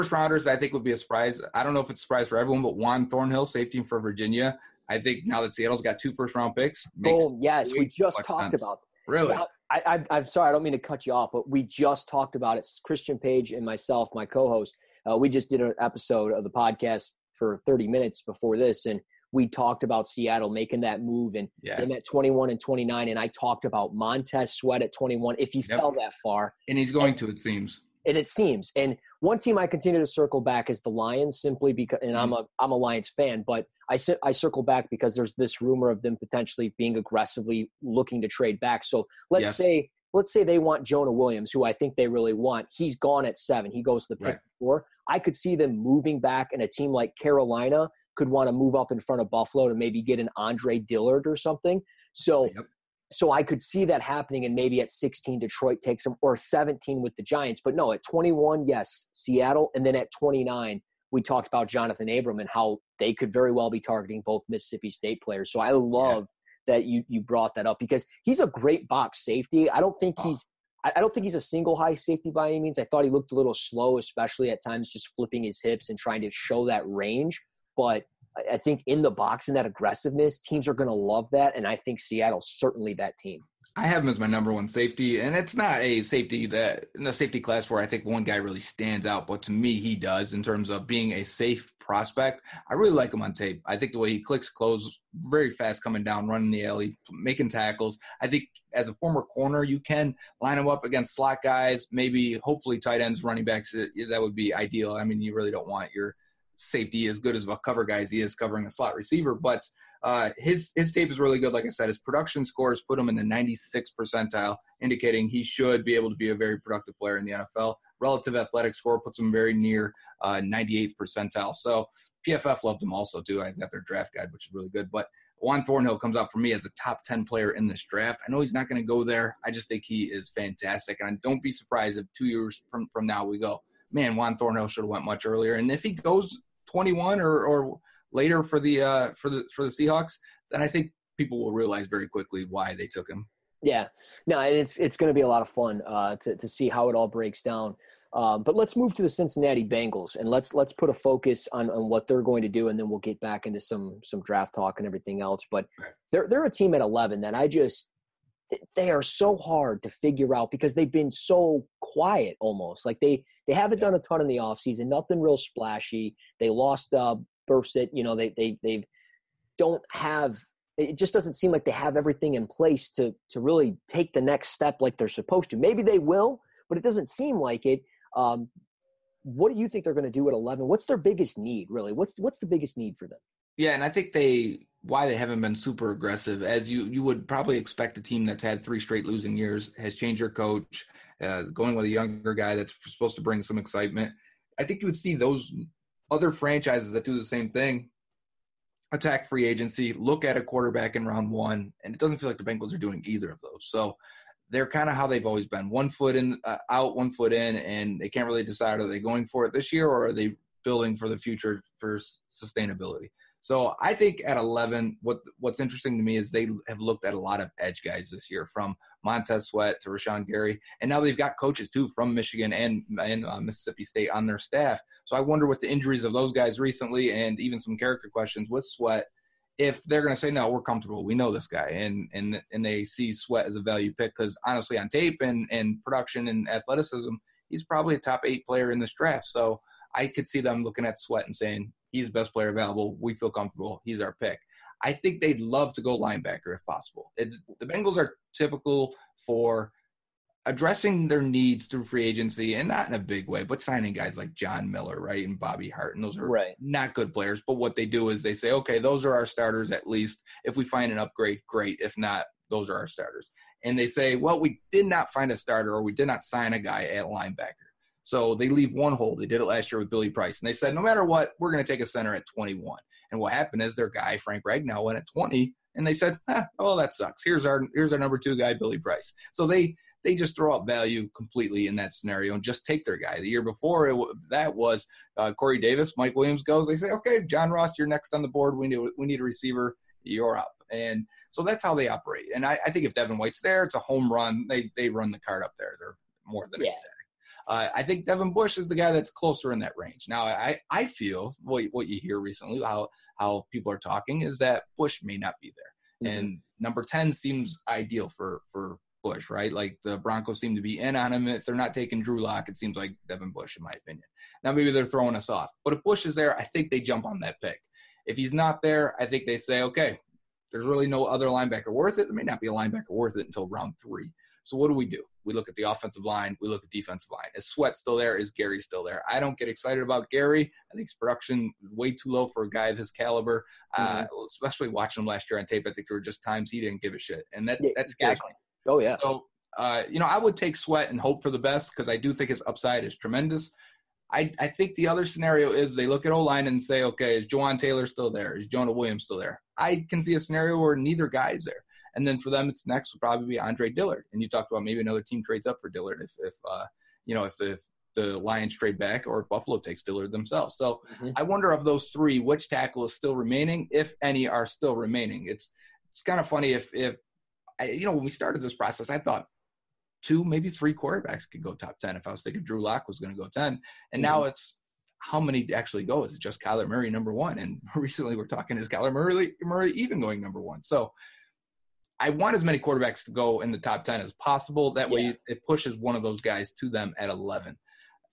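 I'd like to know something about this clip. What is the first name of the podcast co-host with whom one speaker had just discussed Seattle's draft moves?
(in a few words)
Christian.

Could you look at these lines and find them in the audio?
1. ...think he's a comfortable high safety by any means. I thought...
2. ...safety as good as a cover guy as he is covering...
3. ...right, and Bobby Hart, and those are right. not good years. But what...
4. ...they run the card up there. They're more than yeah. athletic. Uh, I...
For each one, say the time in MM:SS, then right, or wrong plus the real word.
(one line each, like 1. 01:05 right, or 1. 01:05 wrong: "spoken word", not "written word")
1. 01:11 wrong: "single", not "comfortable"
2. 01:46 right
3. 04:14 wrong: "players", not "years"
4. 04:54 wrong: "ecstatic", not "athletic".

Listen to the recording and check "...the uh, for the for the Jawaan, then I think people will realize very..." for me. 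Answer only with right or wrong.
wrong.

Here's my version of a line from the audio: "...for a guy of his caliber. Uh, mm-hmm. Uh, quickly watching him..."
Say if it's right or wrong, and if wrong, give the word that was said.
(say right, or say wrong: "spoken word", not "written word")
wrong: "especially", not "quickly".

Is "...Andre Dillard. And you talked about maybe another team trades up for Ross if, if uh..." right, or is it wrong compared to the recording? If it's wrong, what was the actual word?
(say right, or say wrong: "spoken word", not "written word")
wrong: "Dillard", not "Ross".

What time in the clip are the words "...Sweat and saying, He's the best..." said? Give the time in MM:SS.
04:00.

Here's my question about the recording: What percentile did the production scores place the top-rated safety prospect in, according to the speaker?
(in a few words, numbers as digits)
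96th.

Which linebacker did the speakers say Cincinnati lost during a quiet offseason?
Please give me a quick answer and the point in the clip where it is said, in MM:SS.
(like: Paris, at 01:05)
Burfict, at 02:47.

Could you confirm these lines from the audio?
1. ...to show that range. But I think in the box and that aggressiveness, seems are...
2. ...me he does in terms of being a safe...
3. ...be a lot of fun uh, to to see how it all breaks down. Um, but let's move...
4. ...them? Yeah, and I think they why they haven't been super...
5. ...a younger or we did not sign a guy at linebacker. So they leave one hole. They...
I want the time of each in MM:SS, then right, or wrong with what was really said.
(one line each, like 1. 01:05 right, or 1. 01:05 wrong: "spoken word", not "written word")
1. 01:16 wrong: "teams", not "seems"
2. 01:29 right
3. 02:25 right
4. 03:03 right
5. 04:25 wrong: "starter", not "younger".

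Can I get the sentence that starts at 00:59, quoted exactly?
And then at 29, we talked about Johnathan Abram and how they could very well be targeting both Mississippi State players.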